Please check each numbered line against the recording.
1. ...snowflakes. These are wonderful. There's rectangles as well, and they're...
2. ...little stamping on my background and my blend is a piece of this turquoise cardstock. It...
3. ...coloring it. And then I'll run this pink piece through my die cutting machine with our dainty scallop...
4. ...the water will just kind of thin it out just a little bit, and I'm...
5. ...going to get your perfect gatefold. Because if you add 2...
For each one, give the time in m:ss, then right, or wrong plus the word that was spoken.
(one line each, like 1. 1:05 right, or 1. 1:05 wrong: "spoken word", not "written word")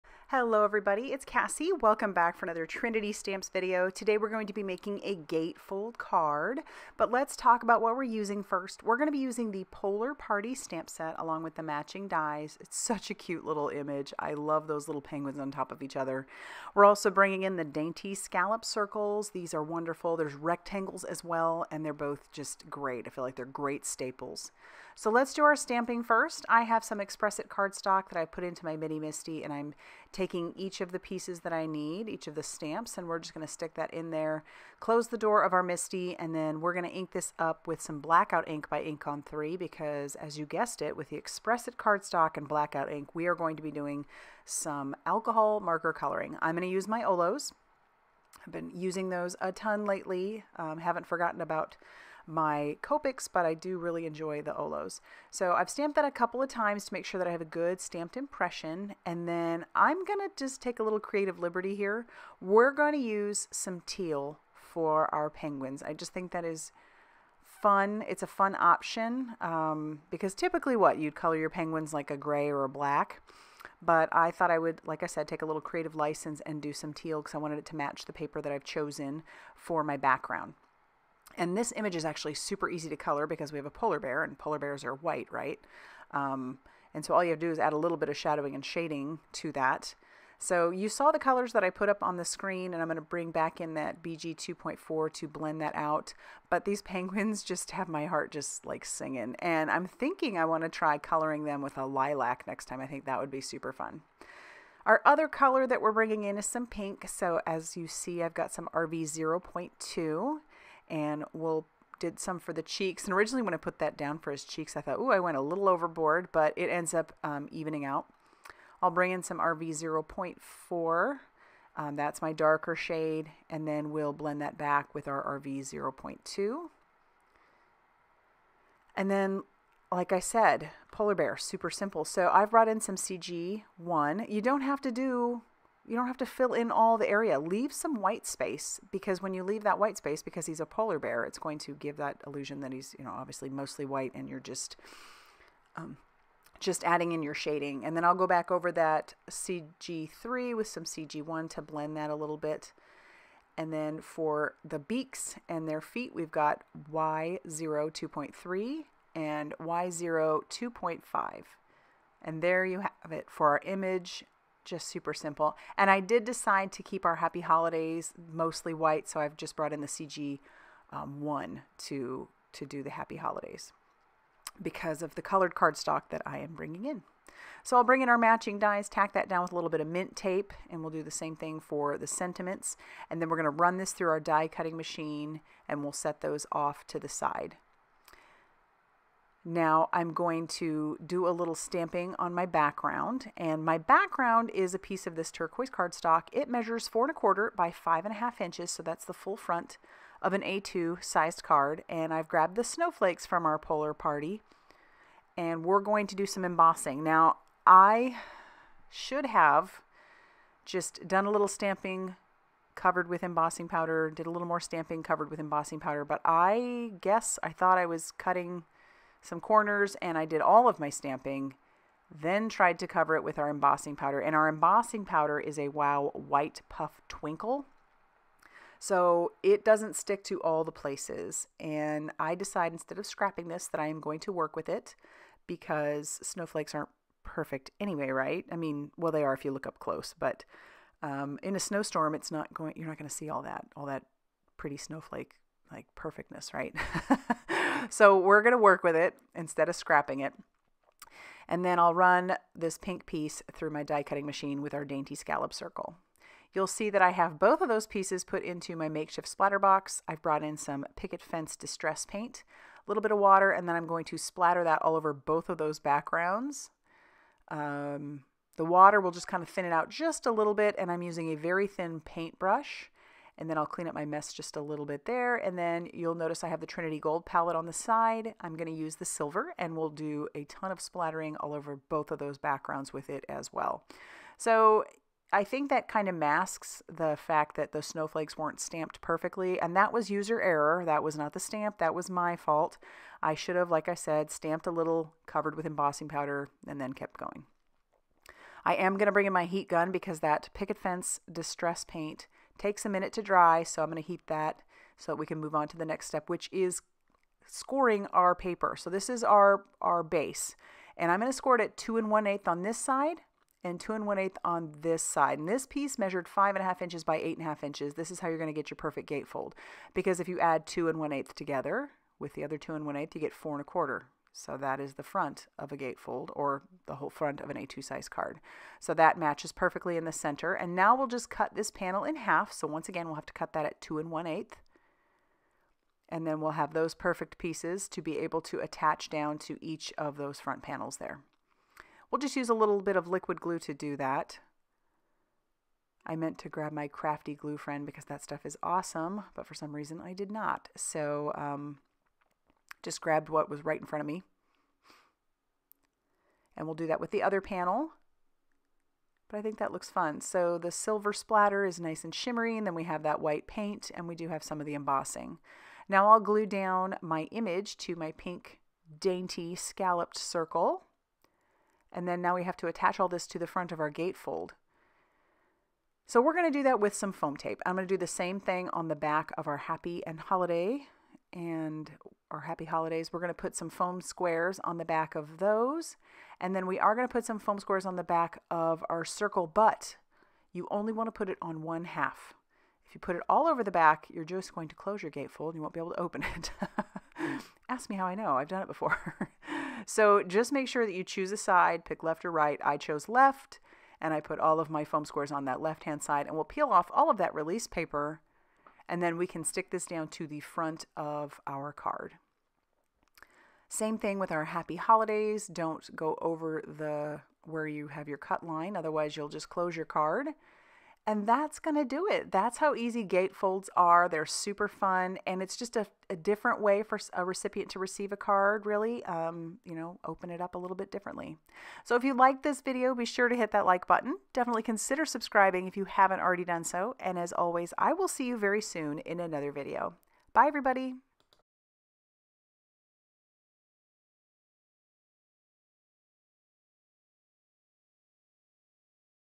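1. 0:18 wrong: "circles", not "snowflakes"
2. 3:11 wrong: "background", not "blend"
3. 4:09 wrong: "scrapping", not "coloring"
4. 4:28 right
5. 5:18 right.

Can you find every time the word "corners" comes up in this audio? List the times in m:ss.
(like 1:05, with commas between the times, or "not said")
3:39.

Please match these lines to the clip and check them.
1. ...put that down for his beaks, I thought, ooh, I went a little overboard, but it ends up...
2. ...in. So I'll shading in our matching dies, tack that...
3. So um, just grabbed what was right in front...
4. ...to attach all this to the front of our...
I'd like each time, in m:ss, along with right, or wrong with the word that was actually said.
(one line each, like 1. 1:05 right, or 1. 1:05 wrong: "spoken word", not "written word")
1. 1:53 wrong: "cheeks", not "beaks"
2. 2:56 wrong: "bring", not "shading"
3. 5:50 right
4. 6:12 right.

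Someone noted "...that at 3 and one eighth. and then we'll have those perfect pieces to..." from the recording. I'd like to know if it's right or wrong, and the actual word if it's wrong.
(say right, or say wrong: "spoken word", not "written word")
wrong: "2", not "3".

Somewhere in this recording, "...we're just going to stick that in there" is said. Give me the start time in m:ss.
0:33.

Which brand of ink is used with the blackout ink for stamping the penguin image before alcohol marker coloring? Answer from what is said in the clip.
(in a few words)
InkOn3.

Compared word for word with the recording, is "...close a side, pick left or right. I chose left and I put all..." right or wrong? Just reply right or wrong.
wrong.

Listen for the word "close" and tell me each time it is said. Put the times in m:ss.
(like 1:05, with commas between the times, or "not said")
0:34, 3:59, 6:34, 6:59.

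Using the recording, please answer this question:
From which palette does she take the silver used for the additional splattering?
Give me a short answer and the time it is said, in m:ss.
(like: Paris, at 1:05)
Trinity Gold palette, at 4:36.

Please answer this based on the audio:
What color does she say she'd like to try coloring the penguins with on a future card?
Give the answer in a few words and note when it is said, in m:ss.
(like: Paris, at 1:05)
Lilac, at 1:41.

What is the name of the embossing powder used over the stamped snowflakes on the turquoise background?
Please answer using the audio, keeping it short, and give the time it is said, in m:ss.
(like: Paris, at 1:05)
Wow White Puff Twinkle, at 3:45.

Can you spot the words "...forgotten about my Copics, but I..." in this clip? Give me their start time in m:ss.
0:51.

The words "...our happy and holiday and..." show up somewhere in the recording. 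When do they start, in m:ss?
6:19.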